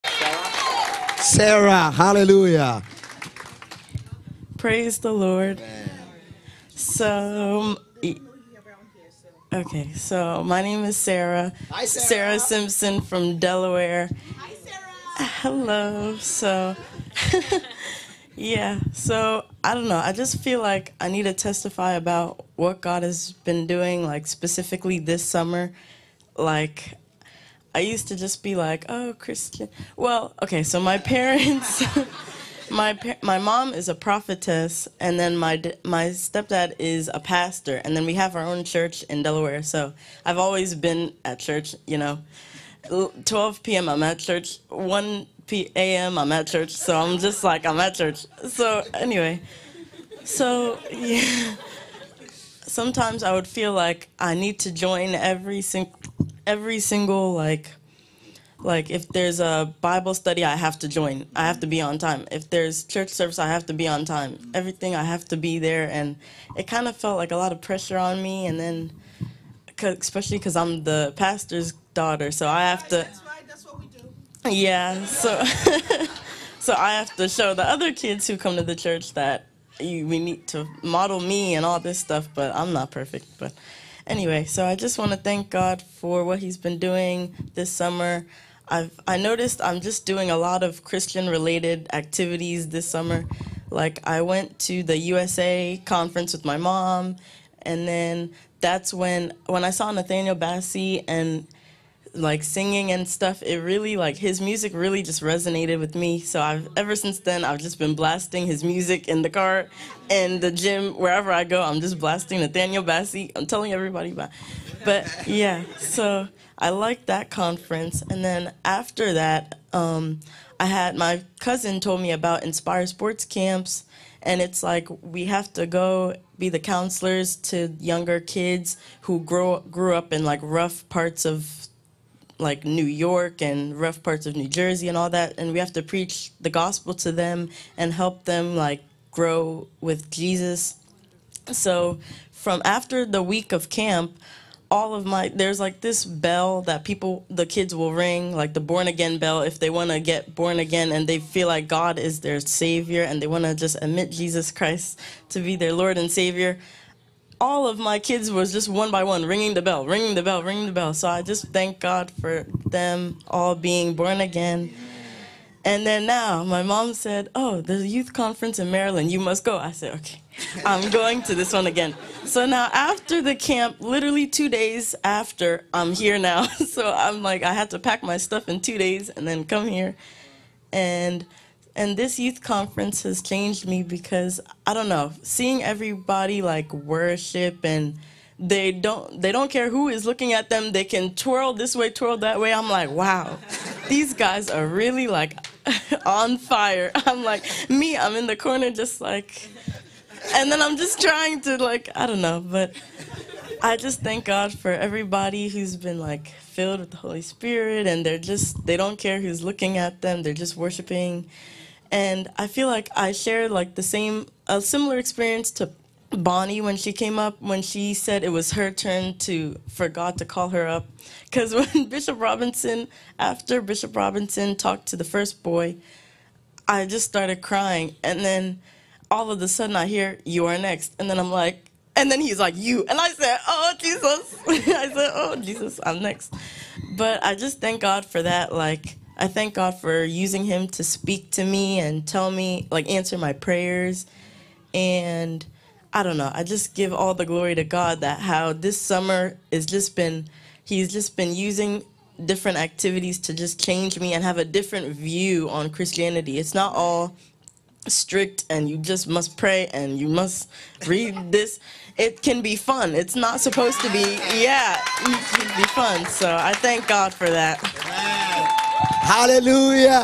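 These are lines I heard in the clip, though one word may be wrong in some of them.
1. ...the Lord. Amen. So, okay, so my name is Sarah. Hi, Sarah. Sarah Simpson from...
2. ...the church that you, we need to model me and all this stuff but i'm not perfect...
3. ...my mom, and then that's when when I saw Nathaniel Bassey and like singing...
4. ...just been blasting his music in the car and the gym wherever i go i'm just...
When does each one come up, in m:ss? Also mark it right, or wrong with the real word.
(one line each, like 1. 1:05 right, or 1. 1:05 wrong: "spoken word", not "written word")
1. 0:04 right
2. 1:18 right
3. 1:36 right
4. 1:47 right.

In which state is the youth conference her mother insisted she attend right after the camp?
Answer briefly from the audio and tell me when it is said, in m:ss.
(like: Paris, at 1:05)
Maryland, at 2:48.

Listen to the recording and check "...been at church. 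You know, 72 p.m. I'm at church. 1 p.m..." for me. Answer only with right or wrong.
wrong.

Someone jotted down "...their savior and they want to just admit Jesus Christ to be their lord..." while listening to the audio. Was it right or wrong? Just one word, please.
right.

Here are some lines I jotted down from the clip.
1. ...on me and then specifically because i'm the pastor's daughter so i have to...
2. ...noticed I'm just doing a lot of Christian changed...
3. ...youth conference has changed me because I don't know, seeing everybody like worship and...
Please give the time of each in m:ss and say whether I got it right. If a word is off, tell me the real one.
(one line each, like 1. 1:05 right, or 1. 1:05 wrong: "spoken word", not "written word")
1. 1:07 wrong: "especially", not "specifically"
2. 1:29 wrong: "related", not "changed"
3. 3:02 right.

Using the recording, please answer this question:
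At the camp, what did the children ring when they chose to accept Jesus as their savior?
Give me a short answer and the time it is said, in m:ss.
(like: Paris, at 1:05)
born again bell, at 2:28.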